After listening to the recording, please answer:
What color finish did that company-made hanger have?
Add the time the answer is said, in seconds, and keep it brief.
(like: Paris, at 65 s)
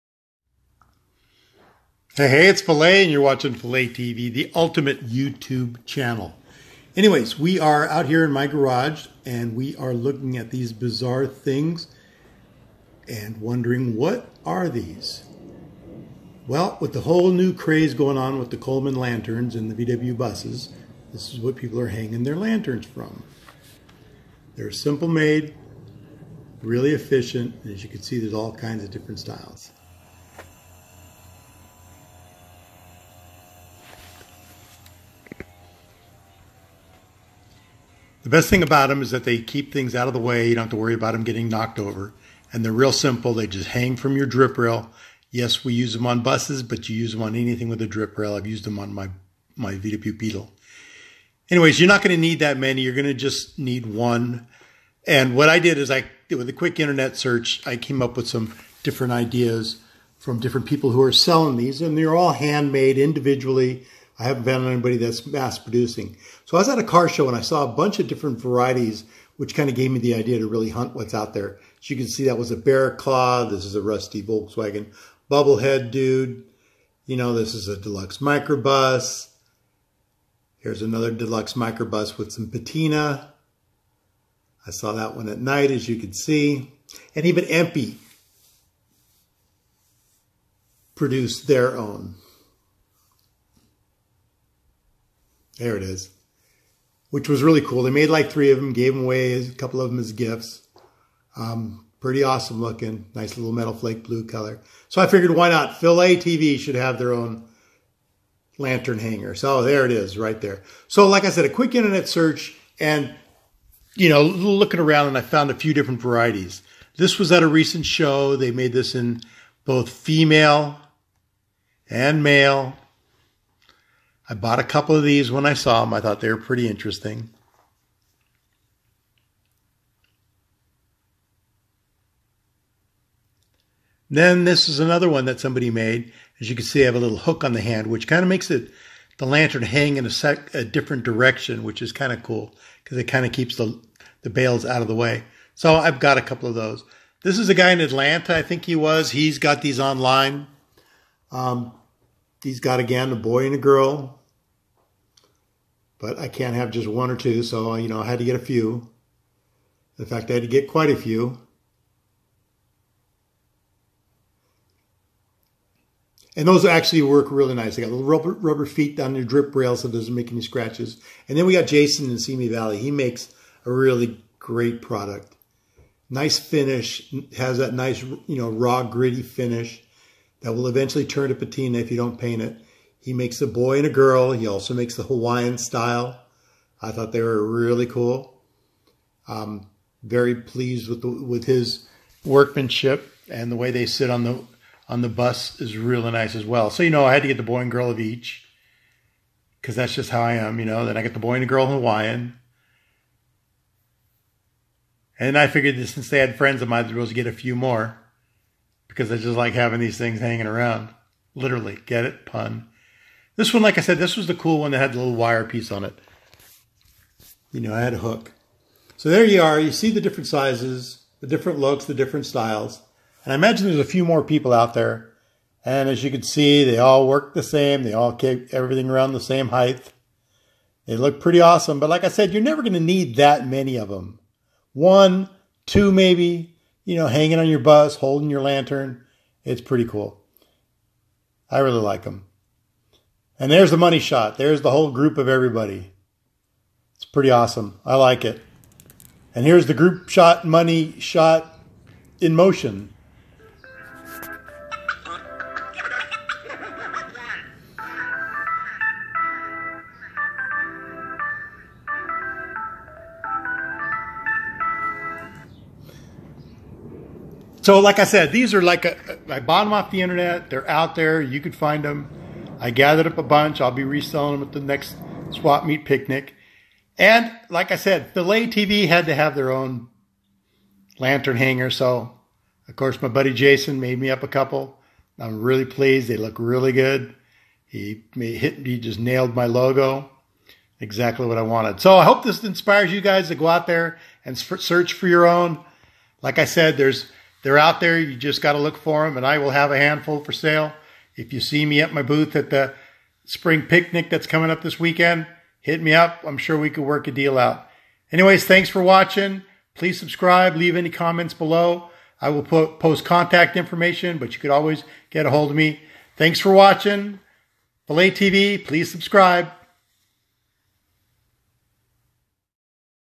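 Metal flake blue, at 103 s.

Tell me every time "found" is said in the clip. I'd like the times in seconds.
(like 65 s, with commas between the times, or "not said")
64 s, 115 s.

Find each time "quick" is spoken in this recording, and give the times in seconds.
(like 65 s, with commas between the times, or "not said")
56 s, 111 s.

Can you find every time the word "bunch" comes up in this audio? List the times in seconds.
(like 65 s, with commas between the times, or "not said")
67 s, 273 s.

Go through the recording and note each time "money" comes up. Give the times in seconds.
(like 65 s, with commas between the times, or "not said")
243 s, 250 s.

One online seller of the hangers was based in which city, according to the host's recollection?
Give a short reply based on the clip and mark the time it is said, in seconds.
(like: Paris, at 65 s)
Atlanta, at 147 s.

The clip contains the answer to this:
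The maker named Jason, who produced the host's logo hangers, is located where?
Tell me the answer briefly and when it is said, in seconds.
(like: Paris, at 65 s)
Simi Valley, at 172 s.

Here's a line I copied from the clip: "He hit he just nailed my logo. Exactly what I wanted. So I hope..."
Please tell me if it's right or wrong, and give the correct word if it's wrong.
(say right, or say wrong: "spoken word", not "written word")
right.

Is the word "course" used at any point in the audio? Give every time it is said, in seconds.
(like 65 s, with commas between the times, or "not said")
282 s.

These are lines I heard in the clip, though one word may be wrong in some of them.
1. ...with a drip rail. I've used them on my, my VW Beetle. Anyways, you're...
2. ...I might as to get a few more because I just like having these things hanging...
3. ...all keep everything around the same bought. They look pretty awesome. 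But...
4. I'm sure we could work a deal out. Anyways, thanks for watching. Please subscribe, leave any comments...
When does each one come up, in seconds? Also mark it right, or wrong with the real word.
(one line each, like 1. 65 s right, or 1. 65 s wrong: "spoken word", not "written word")
1. 47 s right
2. 206 s right
3. 227 s wrong: "height", not "bought"
4. 306 s right.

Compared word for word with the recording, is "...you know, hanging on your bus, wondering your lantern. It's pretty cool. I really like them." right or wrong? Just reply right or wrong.
wrong.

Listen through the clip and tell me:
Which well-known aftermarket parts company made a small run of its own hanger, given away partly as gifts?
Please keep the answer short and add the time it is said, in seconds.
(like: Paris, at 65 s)
EMPI, at 87 s.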